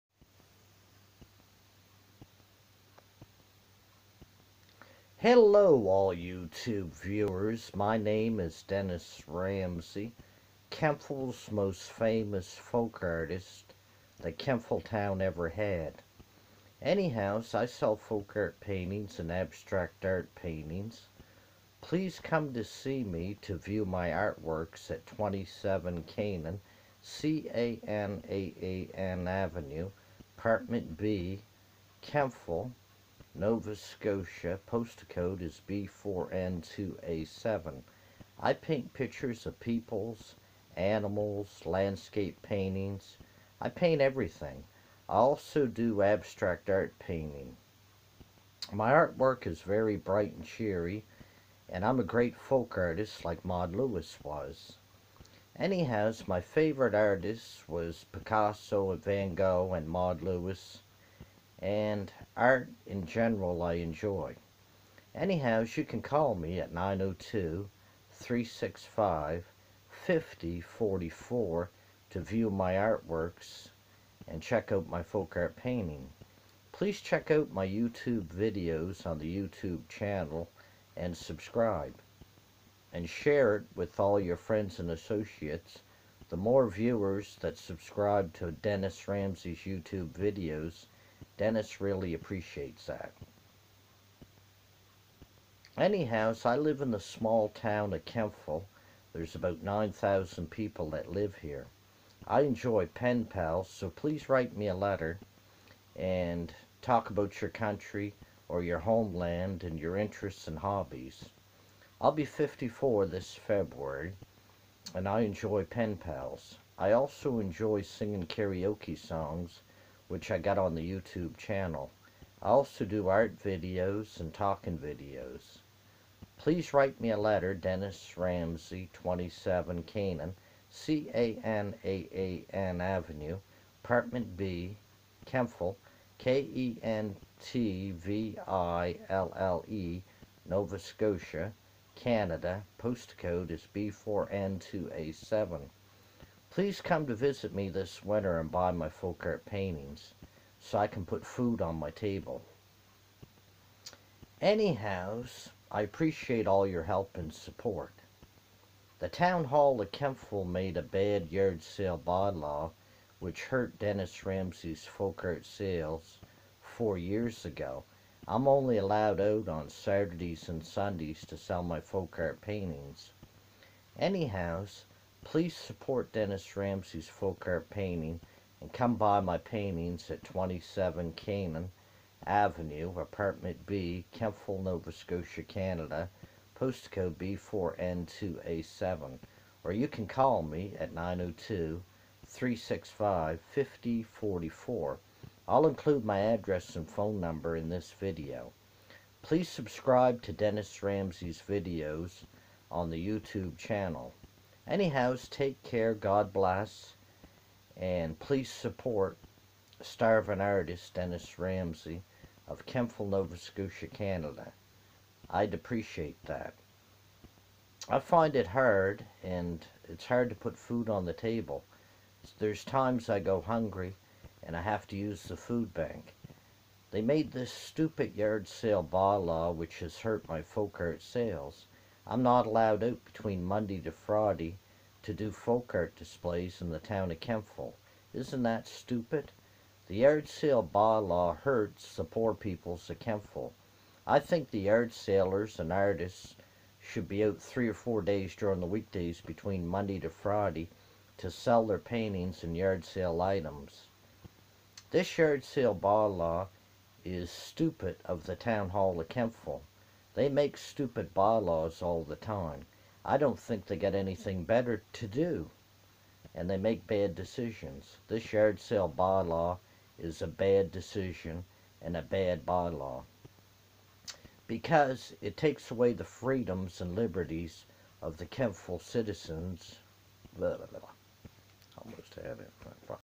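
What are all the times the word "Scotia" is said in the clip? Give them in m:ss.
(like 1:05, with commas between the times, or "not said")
0:33, 2:20, 3:04, 3:33.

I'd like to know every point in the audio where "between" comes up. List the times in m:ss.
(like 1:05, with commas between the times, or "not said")
3:53, 4:09.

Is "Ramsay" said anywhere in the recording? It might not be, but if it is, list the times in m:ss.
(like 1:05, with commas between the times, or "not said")
0:09, 1:29, 2:08, 2:44, 2:56, 3:20, 3:31.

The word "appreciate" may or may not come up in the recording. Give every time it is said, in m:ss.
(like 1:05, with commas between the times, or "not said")
1:32, 2:35, 3:35.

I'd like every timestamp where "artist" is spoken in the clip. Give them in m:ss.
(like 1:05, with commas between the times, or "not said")
0:13, 0:52, 0:56, 3:30, 4:05.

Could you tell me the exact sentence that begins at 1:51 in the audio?
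I'll be 54 this February, and I enjoy pen pals.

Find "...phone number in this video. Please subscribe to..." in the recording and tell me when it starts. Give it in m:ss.
3:16.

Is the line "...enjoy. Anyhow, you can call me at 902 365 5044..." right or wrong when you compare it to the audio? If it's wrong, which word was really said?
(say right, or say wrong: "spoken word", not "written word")
right.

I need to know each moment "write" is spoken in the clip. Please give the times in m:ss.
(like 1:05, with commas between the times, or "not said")
1:44, 2:06.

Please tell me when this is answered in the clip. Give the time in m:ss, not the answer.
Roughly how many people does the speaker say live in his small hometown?
1:39.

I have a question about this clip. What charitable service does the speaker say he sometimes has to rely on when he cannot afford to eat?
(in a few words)
food bank.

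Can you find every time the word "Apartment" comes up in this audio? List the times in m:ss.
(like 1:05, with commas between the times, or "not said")
0:30, 2:13, 3:02.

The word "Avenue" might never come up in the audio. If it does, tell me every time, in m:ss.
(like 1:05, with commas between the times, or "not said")
0:29, 2:12, 3:02.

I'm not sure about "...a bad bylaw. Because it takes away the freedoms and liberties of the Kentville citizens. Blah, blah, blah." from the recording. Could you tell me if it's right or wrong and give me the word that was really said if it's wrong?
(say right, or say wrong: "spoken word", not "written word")
right.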